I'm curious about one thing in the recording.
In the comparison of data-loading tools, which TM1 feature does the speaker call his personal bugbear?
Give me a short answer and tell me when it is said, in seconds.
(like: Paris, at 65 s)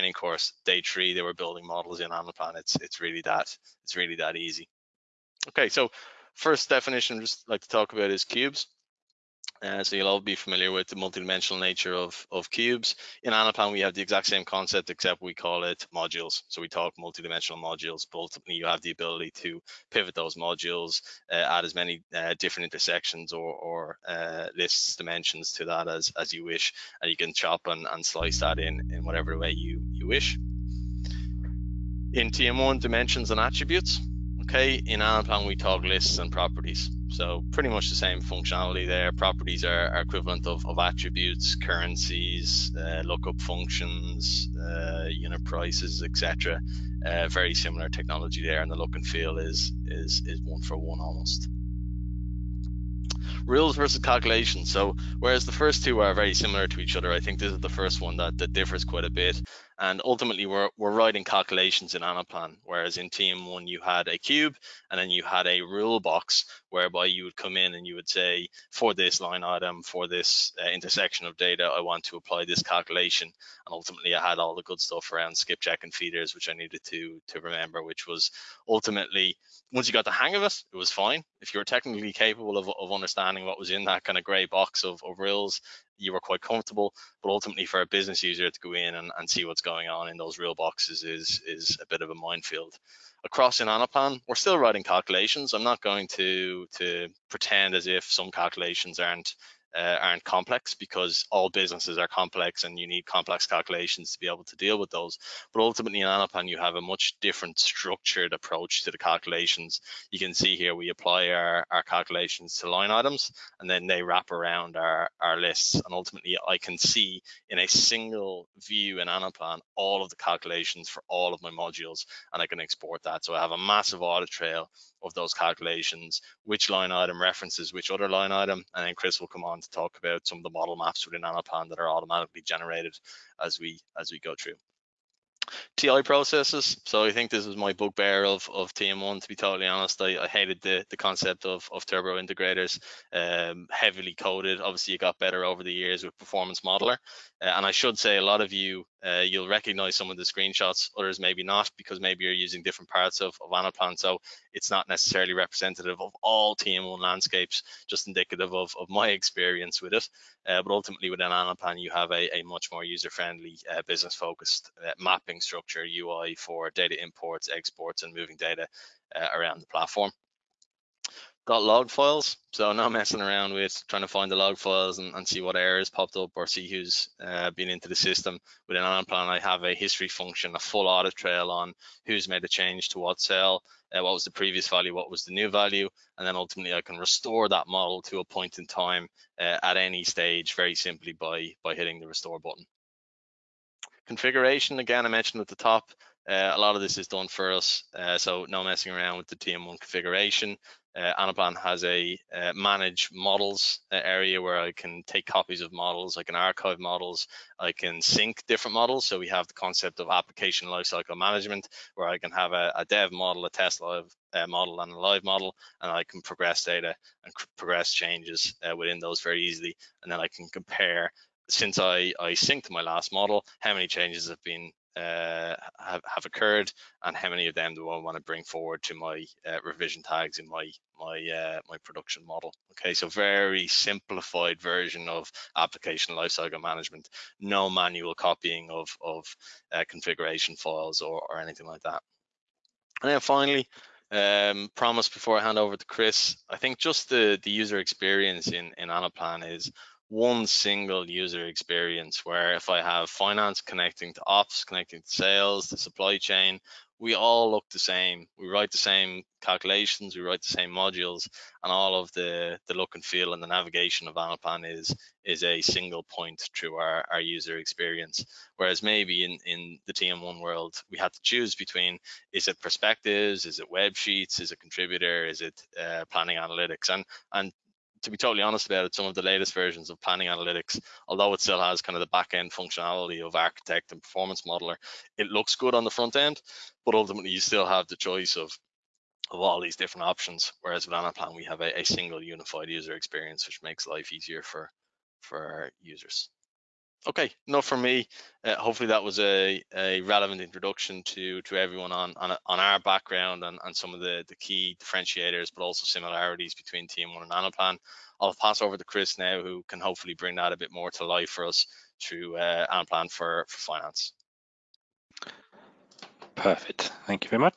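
TI processes, at 135 s.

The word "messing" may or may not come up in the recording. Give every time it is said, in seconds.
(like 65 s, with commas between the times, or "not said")
172 s, 198 s.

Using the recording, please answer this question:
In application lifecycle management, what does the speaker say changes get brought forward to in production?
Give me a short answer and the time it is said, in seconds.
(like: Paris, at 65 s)
Revision tags, at 229 s.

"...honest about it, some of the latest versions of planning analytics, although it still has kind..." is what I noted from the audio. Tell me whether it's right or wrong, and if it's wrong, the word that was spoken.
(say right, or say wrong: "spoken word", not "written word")
right.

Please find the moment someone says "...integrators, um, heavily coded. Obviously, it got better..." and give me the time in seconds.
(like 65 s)
142 s.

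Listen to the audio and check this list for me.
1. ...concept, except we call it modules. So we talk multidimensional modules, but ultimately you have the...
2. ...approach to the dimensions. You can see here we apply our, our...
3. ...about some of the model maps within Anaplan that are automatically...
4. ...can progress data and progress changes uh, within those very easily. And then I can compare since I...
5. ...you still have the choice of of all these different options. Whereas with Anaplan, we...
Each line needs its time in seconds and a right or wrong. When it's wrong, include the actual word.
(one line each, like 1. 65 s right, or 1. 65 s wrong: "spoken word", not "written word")
1. 14 s right
2. 108 s wrong: "calculations", not "dimensions"
3. 129 s right
4. 216 s right
5. 287 s right.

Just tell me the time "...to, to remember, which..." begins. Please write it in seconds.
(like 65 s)
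76 s.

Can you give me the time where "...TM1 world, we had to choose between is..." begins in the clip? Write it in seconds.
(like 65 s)
269 s.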